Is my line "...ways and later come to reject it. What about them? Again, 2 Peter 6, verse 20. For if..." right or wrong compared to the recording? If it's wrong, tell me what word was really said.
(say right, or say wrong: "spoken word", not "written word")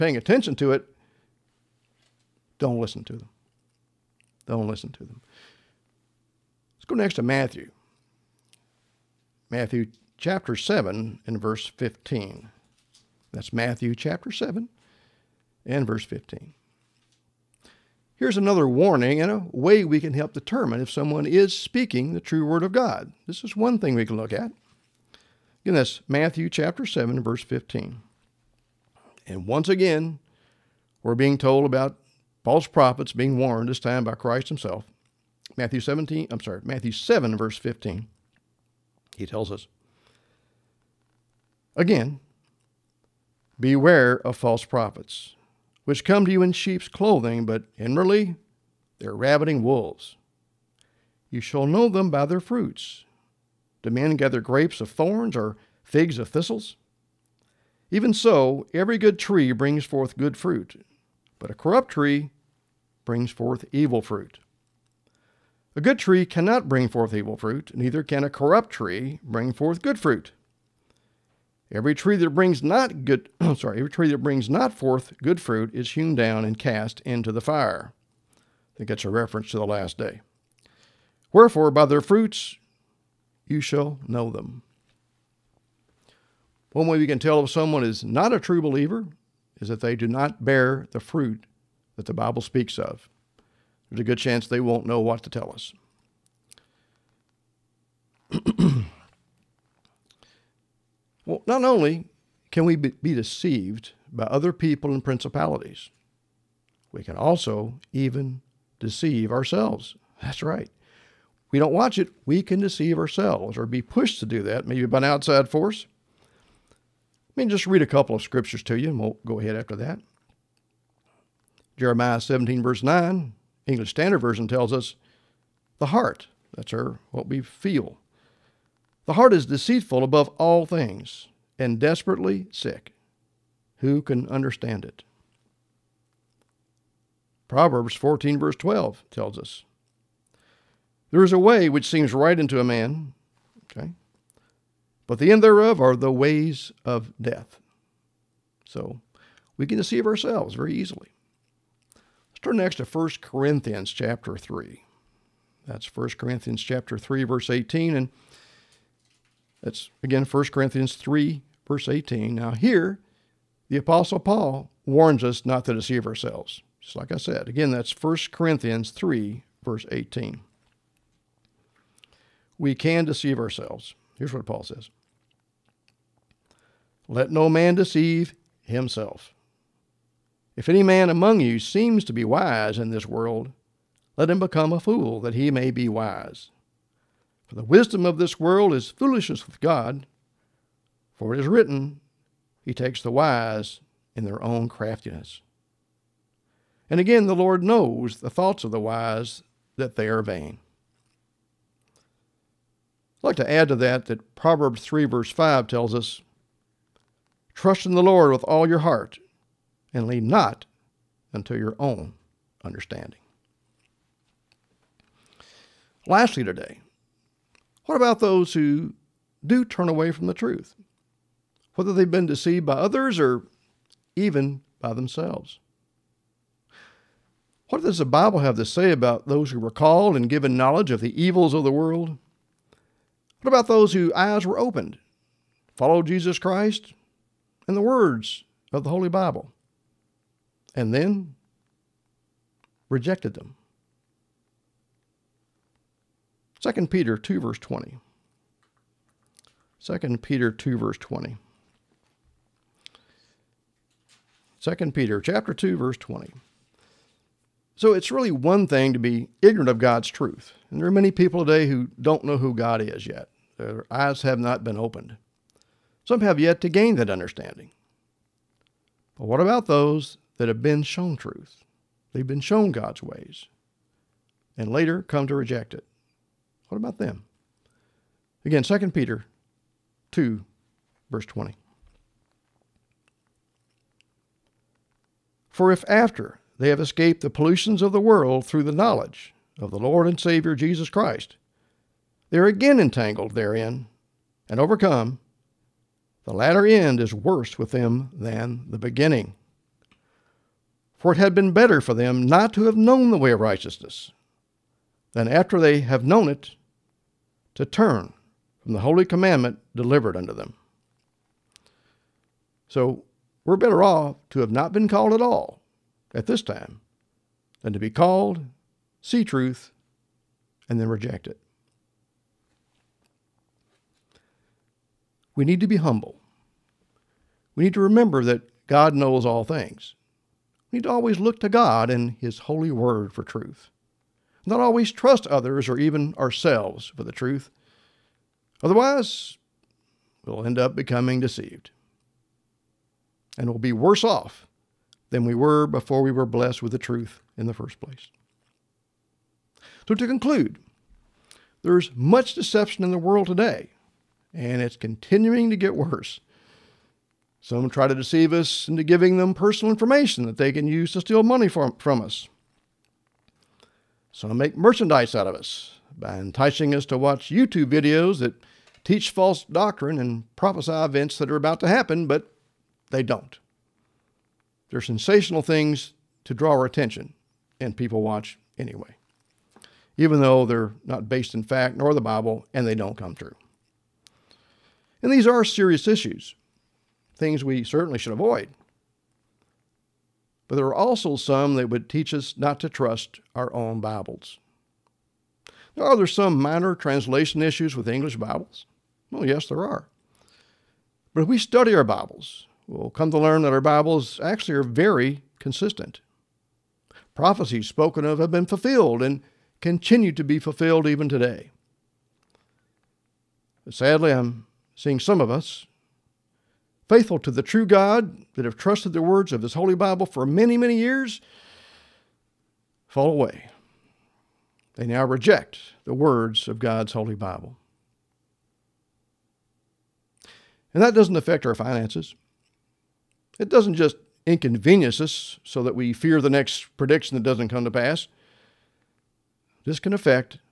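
wrong: "2", not "6".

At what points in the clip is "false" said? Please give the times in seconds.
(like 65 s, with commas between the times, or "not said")
32 s, 44 s, 369 s.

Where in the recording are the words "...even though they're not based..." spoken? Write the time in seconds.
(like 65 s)
379 s.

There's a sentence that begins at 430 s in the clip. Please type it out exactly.
And that doesn't affect our finances.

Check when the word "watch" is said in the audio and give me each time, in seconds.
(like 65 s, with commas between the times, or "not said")
111 s, 366 s, 378 s.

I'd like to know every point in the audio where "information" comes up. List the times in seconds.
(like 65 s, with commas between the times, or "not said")
359 s.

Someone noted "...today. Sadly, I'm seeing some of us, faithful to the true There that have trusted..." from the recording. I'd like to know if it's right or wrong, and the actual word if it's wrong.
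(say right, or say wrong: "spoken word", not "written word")
wrong: "God", not "There".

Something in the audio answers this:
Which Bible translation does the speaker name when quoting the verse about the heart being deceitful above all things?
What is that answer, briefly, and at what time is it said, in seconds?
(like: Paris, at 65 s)
English Standard Version, at 123 s.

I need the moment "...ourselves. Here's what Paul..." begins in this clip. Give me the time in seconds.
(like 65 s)
173 s.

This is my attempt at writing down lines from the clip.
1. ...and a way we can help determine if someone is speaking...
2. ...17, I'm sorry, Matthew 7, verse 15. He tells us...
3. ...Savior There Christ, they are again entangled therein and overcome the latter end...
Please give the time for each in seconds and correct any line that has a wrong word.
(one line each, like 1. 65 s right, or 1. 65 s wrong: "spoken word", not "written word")
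1. 19 s right
2. 35 s right
3. 290 s wrong: "Jesus", not "There".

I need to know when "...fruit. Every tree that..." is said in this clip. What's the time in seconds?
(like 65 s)
69 s.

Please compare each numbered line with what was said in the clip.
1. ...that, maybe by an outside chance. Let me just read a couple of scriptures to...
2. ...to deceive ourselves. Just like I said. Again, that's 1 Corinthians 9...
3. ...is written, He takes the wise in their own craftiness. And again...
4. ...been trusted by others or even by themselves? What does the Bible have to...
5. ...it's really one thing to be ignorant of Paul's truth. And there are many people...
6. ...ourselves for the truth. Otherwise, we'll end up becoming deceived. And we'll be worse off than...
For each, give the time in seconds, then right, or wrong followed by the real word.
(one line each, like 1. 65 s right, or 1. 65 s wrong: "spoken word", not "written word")
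1. 114 s wrong: "force", not "chance"
2. 165 s wrong: "3", not "9"
3. 191 s right
4. 222 s wrong: "deceived", not "trusted"
5. 257 s wrong: "God", not "Paul"
6. 336 s right.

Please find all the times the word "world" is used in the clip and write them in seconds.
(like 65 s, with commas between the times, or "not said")
183 s, 188 s, 231 s, 288 s, 352 s.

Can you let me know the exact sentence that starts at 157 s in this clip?
And that's again 1 Corinthians 3, verse 18.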